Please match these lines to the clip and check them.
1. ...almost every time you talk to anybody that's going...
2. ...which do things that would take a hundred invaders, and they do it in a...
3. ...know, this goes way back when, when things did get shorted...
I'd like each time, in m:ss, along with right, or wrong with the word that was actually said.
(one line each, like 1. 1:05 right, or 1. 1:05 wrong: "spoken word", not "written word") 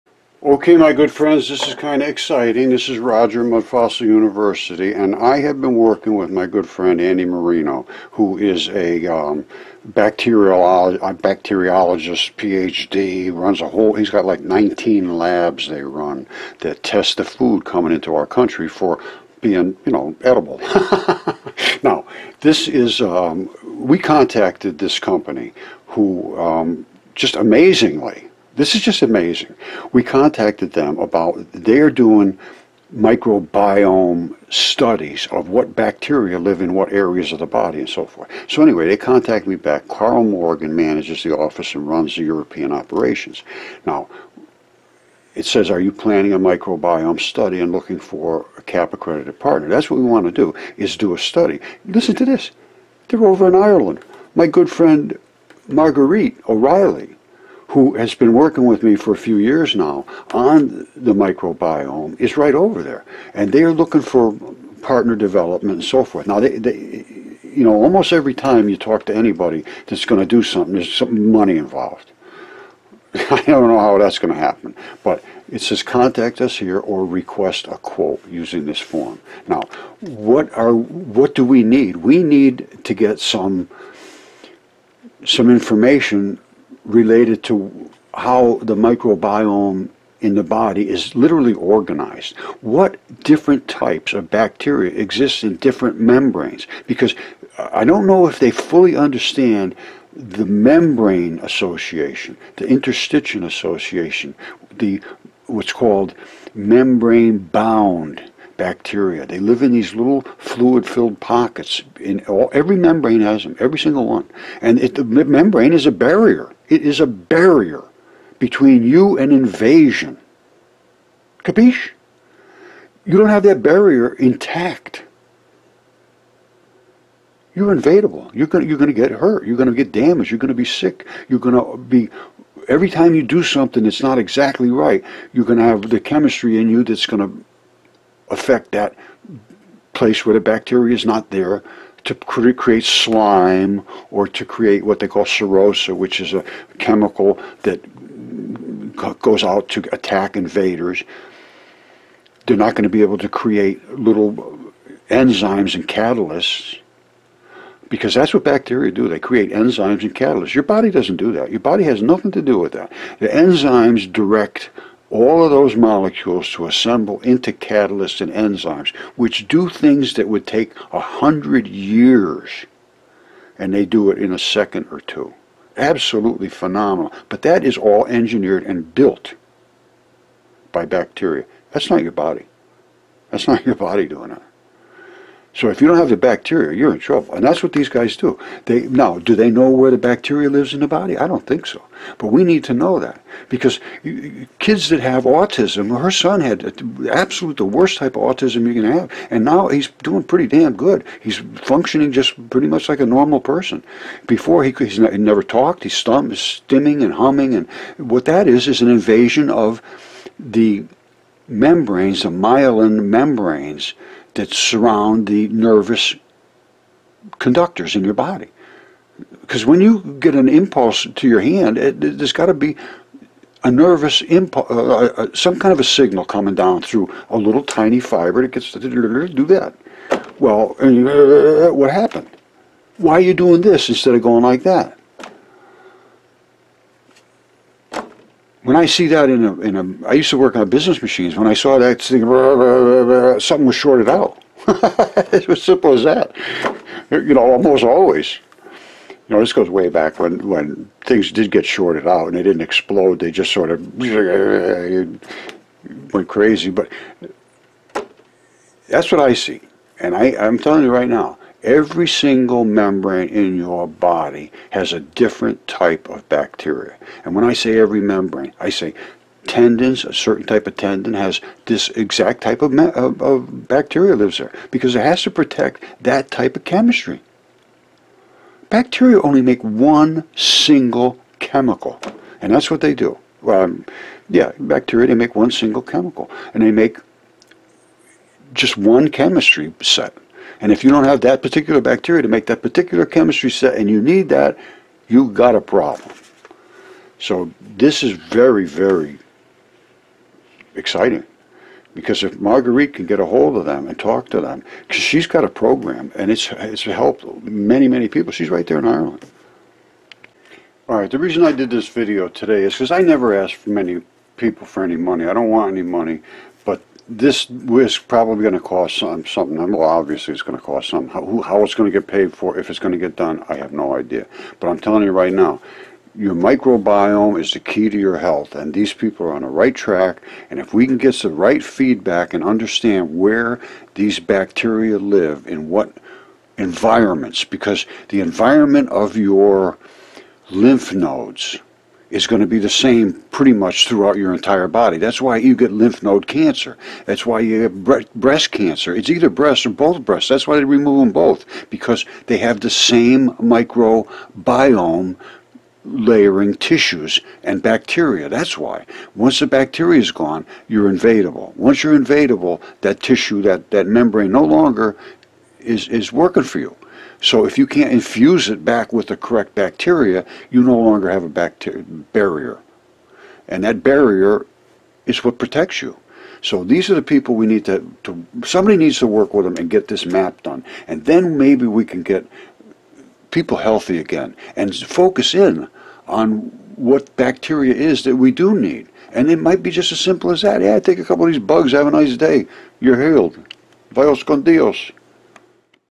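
1. 1:07 right
2. 2:49 wrong: "years", not "invaders"
3. 4:09 right.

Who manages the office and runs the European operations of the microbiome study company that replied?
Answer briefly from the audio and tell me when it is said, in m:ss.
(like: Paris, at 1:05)
Carl Morgan, at 0:39.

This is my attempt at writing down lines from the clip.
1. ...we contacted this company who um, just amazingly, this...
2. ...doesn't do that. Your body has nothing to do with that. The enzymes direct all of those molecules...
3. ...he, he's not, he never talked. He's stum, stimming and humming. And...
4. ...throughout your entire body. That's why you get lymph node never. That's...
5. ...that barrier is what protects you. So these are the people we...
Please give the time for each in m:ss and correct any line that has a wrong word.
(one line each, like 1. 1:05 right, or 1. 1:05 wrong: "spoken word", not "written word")
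1. 0:23 right
2. 2:40 right
3. 3:24 right
4. 5:43 wrong: "cancer", not "never"
5. 6:13 right.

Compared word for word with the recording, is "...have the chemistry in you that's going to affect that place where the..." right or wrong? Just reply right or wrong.
right.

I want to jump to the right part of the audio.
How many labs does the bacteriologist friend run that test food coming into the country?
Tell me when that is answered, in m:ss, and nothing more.
0:14.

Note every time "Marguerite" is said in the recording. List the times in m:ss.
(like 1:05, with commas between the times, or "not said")
0:55, 5:02.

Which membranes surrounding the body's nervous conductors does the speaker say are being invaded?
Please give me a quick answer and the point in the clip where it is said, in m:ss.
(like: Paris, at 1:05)
myelin membranes, at 3:32.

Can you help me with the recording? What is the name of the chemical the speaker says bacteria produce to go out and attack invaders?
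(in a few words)
serosa.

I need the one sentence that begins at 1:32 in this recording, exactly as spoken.
What different types of bacteria exist in different membranes?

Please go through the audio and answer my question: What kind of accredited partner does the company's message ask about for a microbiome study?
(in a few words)
CAP accredited.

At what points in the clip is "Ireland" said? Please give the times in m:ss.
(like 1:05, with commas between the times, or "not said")
0:53, 5:08.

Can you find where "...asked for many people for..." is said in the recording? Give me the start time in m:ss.
5:13.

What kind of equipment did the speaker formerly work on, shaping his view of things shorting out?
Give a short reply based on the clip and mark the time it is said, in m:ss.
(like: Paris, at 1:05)
business machines, at 4:00.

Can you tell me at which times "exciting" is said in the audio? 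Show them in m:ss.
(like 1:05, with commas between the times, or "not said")
0:02, 5:00.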